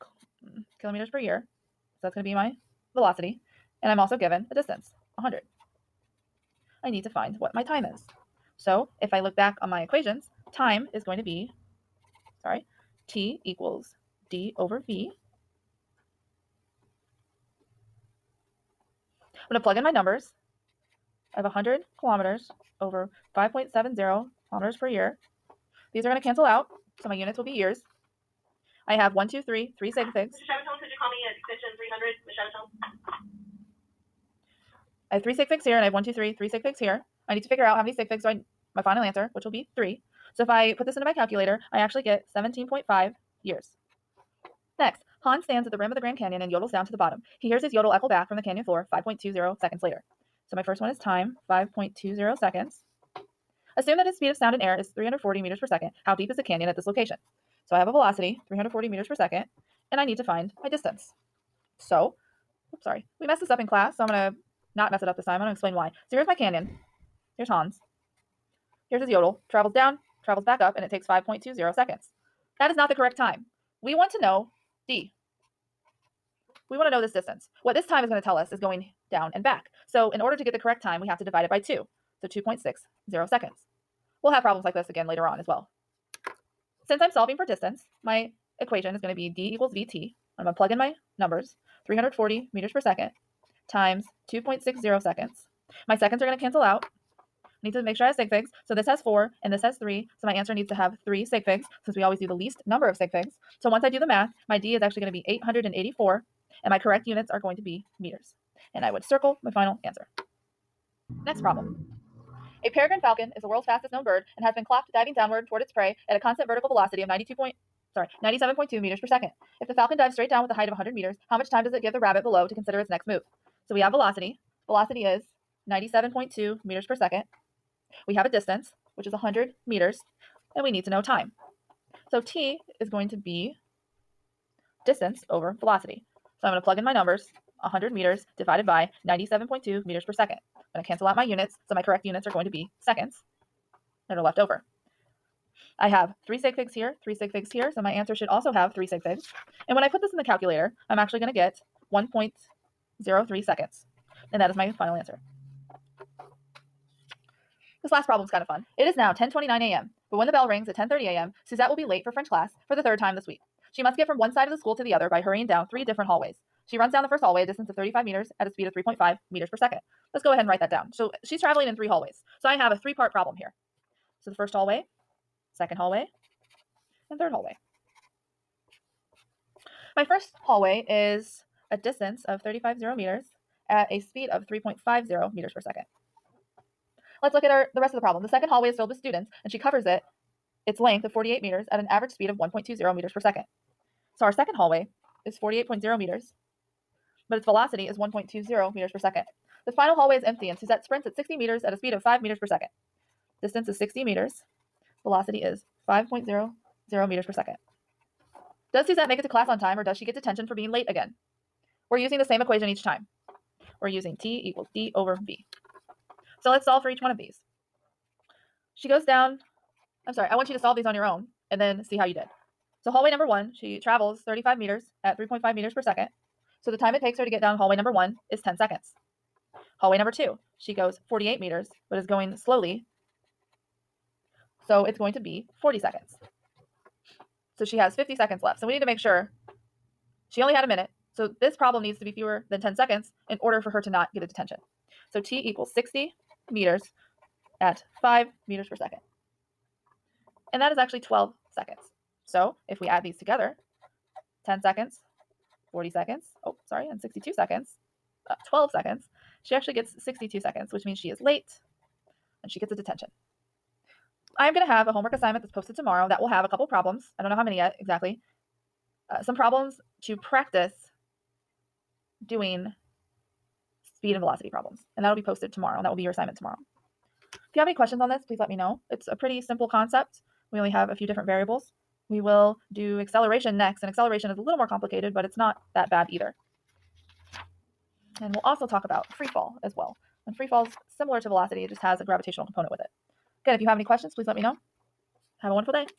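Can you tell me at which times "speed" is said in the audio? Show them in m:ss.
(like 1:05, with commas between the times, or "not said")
0:54, 2:48, 3:03, 3:12, 3:21, 4:33.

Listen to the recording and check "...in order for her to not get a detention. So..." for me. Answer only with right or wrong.
right.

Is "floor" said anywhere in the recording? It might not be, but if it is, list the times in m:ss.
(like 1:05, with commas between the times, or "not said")
0:48.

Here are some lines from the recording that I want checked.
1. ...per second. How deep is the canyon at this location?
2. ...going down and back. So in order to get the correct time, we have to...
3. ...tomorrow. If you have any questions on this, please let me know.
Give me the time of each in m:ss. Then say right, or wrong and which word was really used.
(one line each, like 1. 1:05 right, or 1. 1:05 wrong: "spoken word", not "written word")
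1. 0:55 right
2. 1:18 right
3. 4:36 right.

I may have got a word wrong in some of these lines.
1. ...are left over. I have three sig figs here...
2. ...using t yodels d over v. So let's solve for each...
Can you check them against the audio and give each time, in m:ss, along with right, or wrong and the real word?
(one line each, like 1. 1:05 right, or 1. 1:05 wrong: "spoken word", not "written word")
1. 2:24 right
2. 3:33 wrong: "equals", not "yodels".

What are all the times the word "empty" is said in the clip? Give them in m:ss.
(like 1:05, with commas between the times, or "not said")
3:20.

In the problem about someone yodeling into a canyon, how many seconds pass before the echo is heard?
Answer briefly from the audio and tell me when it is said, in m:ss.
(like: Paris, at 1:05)
5.20 seconds, at 0:48.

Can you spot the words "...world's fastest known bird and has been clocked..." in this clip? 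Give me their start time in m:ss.
1:53.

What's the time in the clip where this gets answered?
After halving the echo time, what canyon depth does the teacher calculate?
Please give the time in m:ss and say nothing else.
1:45.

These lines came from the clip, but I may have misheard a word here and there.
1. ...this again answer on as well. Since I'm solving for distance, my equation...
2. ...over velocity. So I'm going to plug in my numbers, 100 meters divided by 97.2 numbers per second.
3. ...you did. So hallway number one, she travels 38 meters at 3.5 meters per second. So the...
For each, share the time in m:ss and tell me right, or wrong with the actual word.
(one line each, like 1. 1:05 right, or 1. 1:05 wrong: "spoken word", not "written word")
1. 1:24 wrong: "later", not "answer"
2. 2:15 wrong: "meters", not "numbers"
3. 3:42 wrong: "35", not "38".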